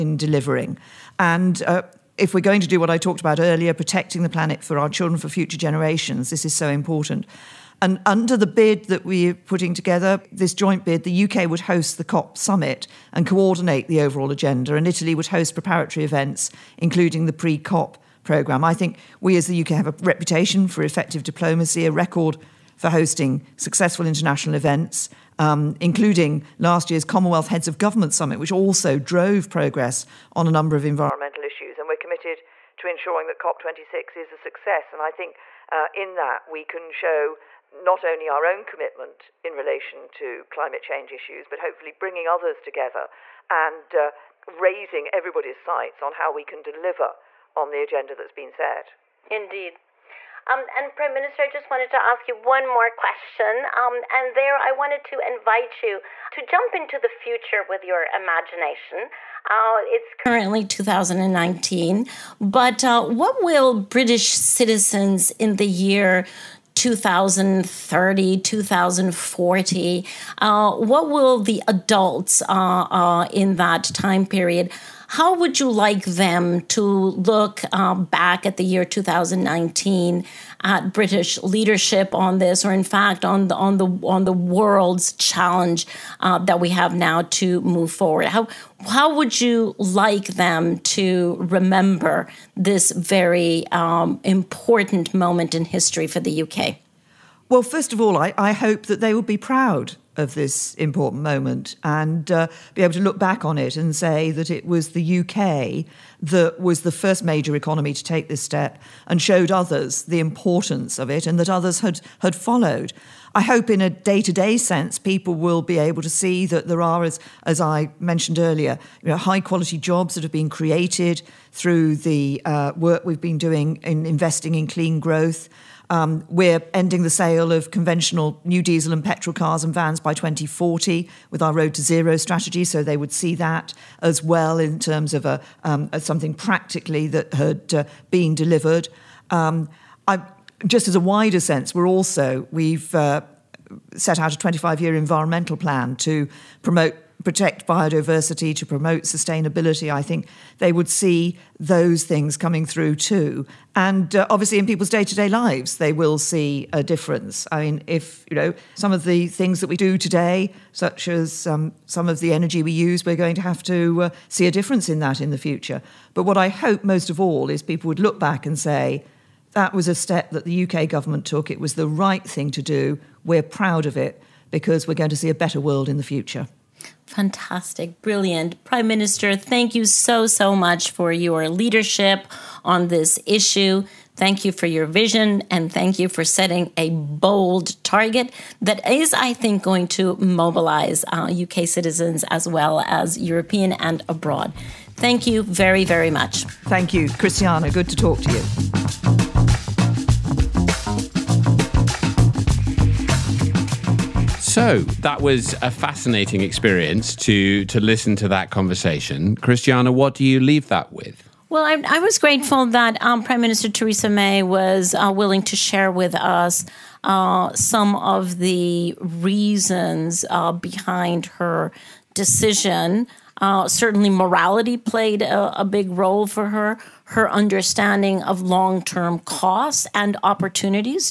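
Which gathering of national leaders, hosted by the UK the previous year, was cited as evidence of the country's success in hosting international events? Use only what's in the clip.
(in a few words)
Commonwealth Heads of Government Summit.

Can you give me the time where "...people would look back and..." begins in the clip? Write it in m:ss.
2:47.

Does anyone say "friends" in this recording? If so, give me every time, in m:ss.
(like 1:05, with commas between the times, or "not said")
not said.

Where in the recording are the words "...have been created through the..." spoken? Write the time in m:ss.
2:00.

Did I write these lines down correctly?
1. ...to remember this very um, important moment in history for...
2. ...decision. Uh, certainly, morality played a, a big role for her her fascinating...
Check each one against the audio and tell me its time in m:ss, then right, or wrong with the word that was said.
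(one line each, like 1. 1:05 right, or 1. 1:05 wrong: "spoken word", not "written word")
1. 1:30 right
2. 3:42 wrong: "understanding", not "fascinating".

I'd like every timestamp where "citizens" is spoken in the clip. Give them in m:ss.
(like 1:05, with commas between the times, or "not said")
1:04, 3:11.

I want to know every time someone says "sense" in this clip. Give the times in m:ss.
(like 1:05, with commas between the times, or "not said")
1:54, 2:21.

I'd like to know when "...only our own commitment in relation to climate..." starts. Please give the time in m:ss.
0:38.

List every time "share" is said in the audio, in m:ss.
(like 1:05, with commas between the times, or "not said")
3:35.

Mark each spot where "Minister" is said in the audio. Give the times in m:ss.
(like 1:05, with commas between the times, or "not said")
0:51, 2:58, 3:33.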